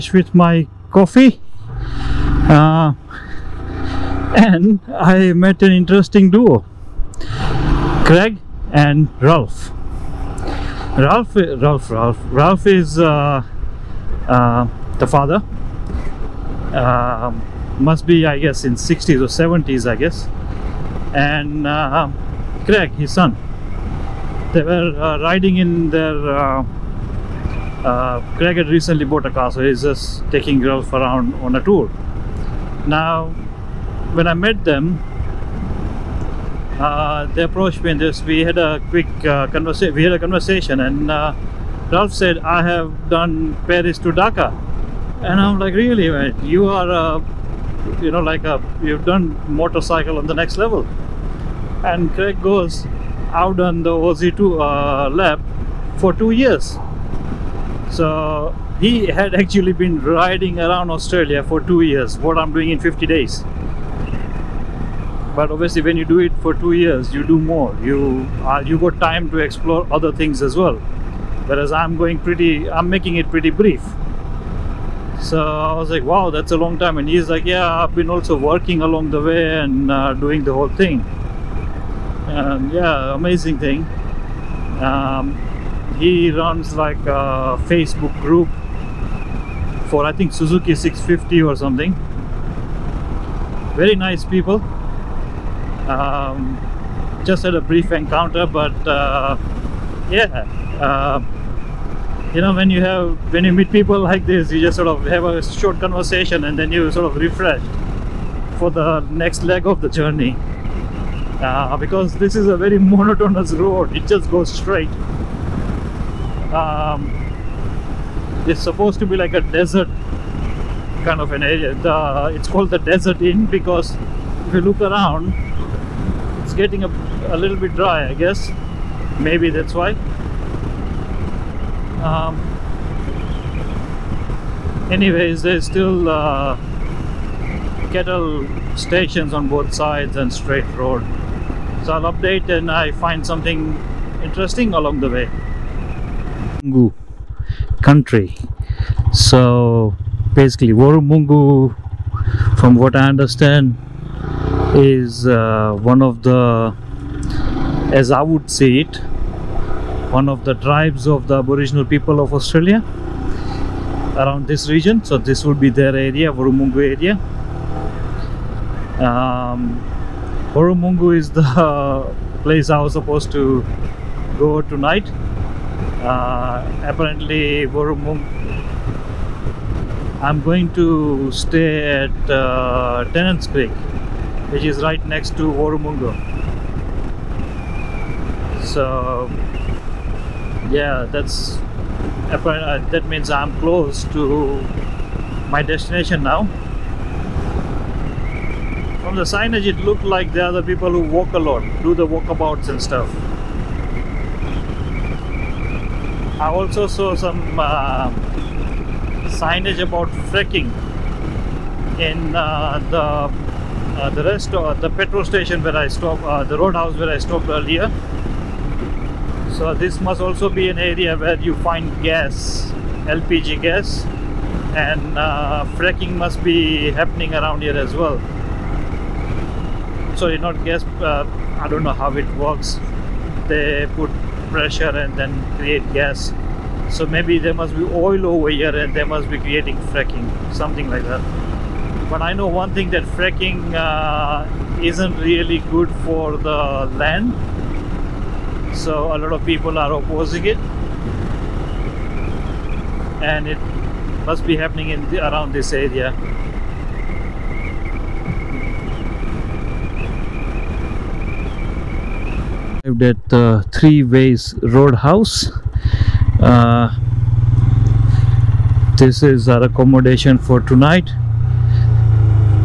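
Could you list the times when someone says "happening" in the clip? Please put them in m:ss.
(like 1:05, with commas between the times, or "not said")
3:46, 4:14.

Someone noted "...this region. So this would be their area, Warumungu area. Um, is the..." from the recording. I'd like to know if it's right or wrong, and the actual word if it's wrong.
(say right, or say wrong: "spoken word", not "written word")
right.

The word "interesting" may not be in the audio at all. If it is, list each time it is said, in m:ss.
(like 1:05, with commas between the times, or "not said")
0:05, 2:24.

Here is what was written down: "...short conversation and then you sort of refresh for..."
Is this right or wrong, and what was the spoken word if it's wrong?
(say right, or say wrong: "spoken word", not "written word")
right.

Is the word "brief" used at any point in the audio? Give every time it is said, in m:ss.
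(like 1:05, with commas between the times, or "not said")
1:13, 1:37.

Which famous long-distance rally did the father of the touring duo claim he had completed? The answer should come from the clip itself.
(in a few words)
Paris to Dakar.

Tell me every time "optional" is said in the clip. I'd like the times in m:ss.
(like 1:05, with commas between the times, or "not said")
not said.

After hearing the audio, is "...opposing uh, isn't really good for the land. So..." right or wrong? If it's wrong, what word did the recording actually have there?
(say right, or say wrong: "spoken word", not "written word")
wrong: "fracking", not "opposing".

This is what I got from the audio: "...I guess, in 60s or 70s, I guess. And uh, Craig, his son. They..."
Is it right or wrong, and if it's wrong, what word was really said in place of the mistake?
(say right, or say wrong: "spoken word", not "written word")
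right.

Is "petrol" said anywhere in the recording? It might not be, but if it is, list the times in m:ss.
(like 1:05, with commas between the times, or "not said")
3:34.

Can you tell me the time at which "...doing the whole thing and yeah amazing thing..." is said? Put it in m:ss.
1:20.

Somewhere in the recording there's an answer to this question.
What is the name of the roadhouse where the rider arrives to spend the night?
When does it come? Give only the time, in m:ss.
4:23.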